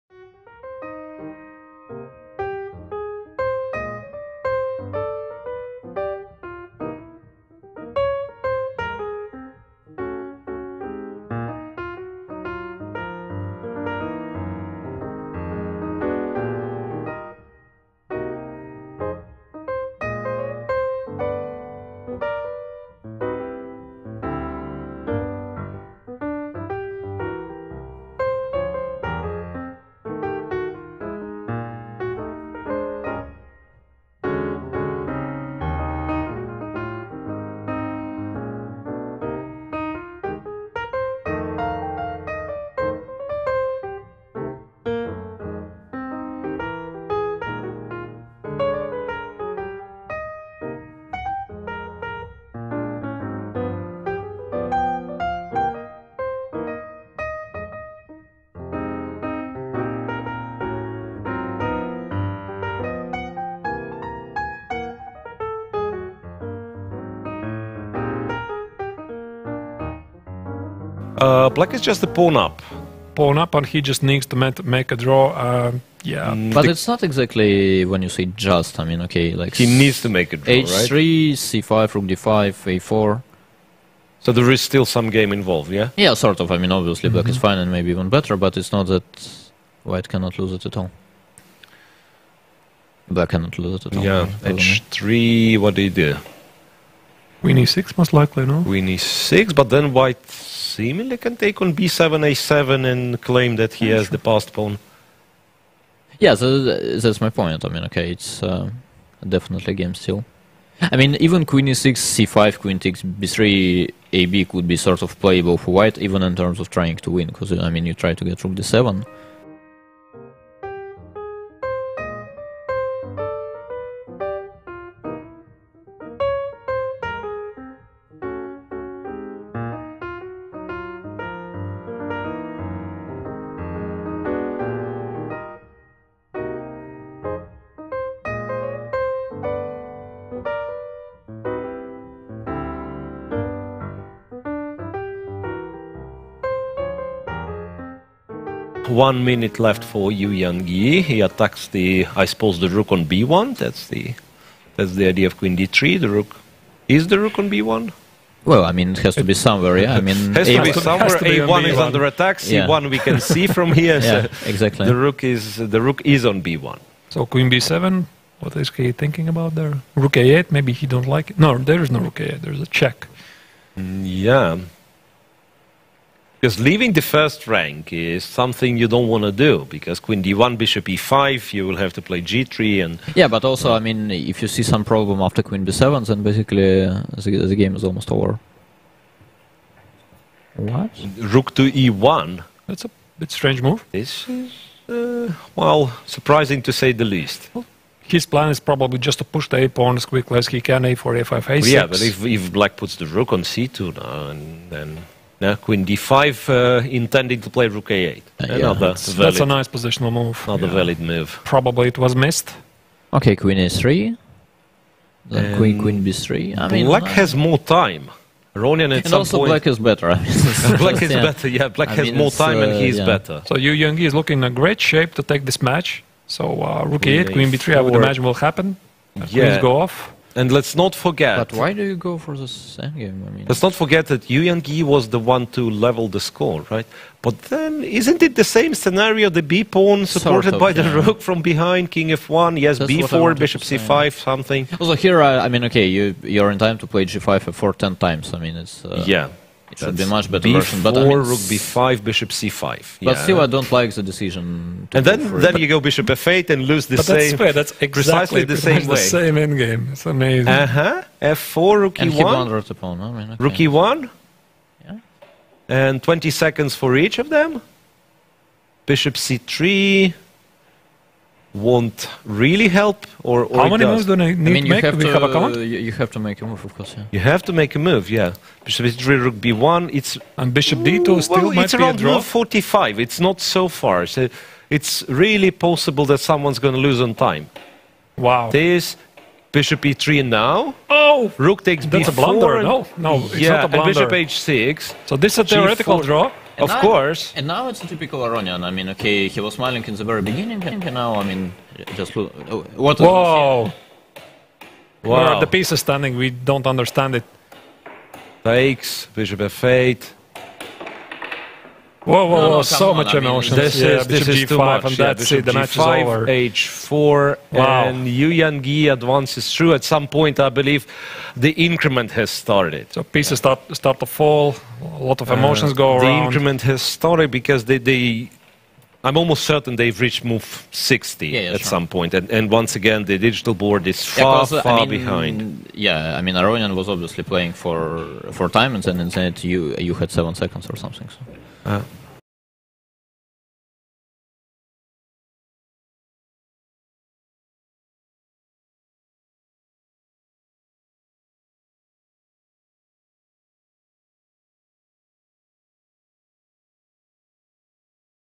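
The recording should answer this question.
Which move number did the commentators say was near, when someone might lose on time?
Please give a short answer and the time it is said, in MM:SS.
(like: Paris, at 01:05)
45, at 04:42.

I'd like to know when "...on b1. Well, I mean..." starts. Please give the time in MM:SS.
02:37.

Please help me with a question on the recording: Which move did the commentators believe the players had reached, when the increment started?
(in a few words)
move 60.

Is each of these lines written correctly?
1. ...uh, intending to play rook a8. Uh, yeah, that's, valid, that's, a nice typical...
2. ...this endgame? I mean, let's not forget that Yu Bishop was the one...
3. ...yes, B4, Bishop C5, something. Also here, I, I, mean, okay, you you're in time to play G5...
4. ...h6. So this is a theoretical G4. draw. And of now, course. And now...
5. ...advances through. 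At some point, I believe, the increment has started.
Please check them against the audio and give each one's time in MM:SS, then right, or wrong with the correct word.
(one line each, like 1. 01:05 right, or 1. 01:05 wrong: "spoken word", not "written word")
1. 03:26 wrong: "positional", not "typical"
2. 03:52 wrong: "Yangyi", not "Bishop"
3. 04:02 right
4. 04:54 right
5. 05:18 right.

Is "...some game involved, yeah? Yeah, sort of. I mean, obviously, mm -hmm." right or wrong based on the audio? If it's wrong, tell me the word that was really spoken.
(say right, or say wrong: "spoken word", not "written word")
right.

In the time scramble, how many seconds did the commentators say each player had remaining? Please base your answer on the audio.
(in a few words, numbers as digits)
20 seconds.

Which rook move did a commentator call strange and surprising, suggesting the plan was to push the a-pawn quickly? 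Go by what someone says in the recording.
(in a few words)
Rook to e1.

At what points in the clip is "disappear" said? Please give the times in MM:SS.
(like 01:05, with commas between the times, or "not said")
not said.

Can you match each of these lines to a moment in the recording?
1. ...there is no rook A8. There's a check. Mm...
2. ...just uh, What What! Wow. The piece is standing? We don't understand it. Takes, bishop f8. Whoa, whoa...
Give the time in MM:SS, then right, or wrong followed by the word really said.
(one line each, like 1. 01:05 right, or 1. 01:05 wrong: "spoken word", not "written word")
1. 02:51 right
2. 05:01 wrong: "Whoa", not "What".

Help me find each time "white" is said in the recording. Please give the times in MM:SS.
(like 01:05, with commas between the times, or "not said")
01:29, 01:39, 01:55.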